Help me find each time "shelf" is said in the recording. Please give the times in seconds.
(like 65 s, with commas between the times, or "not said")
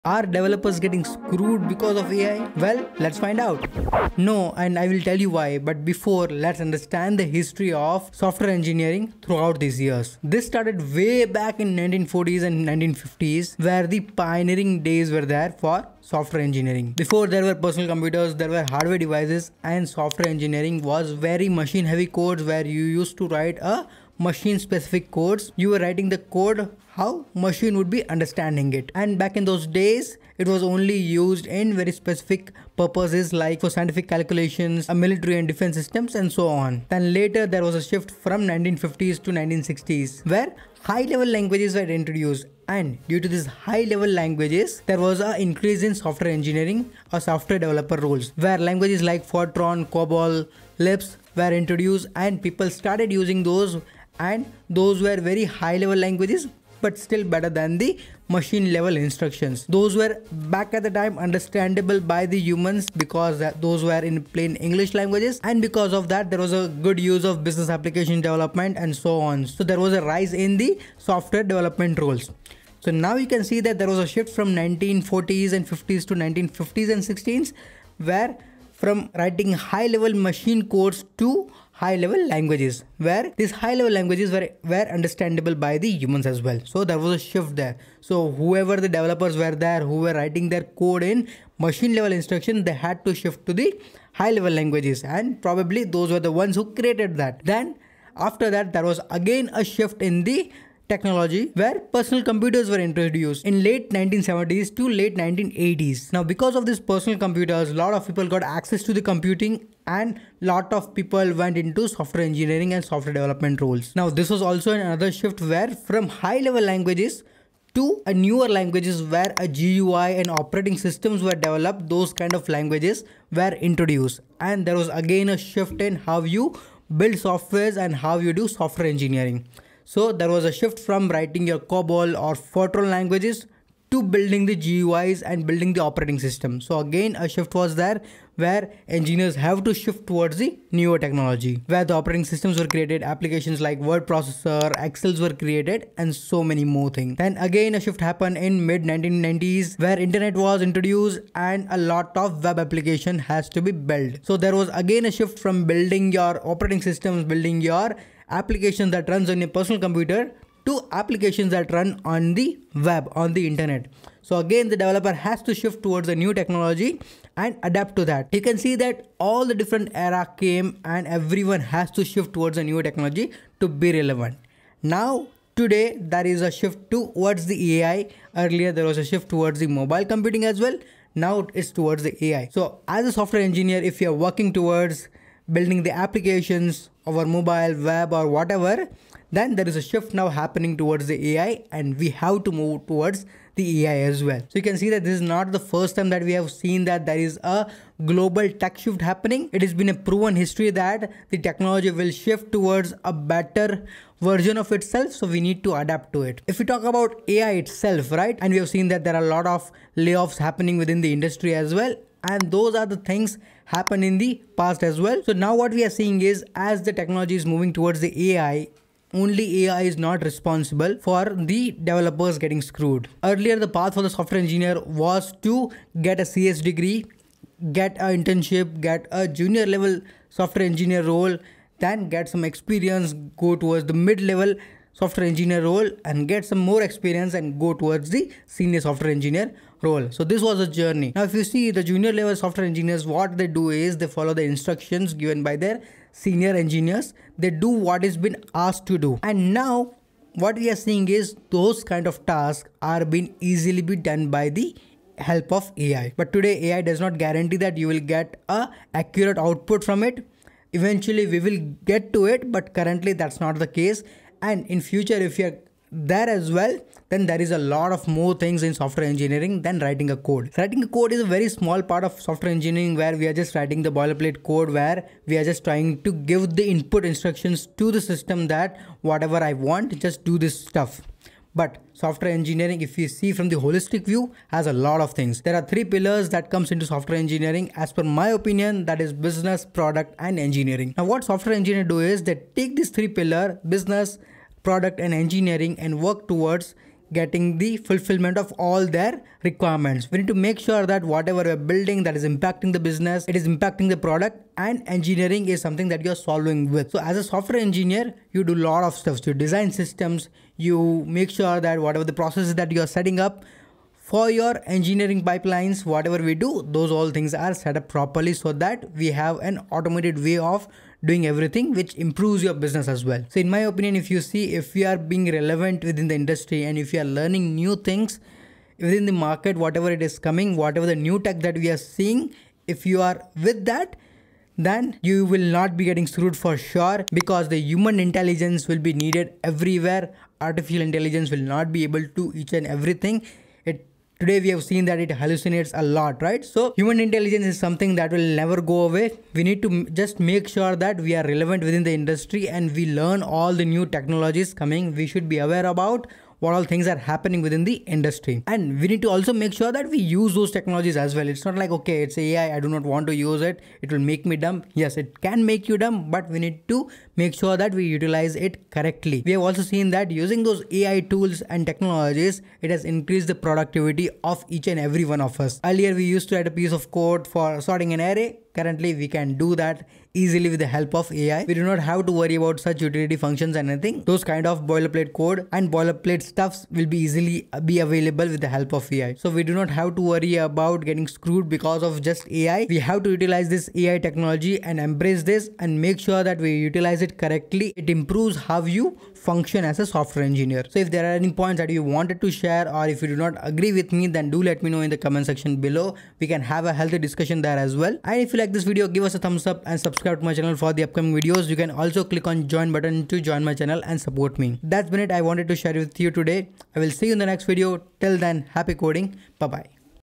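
not said.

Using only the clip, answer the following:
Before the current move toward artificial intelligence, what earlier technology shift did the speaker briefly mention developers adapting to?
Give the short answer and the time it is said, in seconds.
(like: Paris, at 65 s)
Mobile computing, at 179 s.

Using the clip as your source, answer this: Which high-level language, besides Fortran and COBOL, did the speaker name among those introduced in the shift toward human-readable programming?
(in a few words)
Lisp.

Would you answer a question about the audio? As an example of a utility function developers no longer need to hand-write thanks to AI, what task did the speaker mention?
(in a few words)
Sorting an array.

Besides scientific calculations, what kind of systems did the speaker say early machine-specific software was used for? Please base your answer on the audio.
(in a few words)
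Military and defense systems.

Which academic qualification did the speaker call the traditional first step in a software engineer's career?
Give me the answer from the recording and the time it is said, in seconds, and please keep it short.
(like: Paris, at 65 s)
CS degree, at 226 s.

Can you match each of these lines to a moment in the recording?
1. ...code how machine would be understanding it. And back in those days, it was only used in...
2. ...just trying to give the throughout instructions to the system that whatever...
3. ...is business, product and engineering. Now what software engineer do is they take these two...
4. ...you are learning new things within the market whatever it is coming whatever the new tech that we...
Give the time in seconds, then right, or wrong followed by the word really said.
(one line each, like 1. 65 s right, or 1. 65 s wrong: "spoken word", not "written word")
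1. 26 s right
2. 275 s wrong: "input", not "throughout"
3. 289 s wrong: "three", not "two"
4. 326 s right.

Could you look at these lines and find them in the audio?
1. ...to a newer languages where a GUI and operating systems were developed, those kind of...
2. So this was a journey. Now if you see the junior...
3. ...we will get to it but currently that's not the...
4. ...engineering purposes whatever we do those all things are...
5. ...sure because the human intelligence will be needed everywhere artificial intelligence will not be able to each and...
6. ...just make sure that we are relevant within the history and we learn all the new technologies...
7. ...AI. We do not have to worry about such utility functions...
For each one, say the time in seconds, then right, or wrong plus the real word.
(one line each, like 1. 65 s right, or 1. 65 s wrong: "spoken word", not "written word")
1. 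117 s right
2. 240 s right
3. 261 s right
4. 314 s wrong: "pipelines", not "purposes"
5. 336 s right
6. 350 s wrong: "industry", not "history"
7. 381 s right.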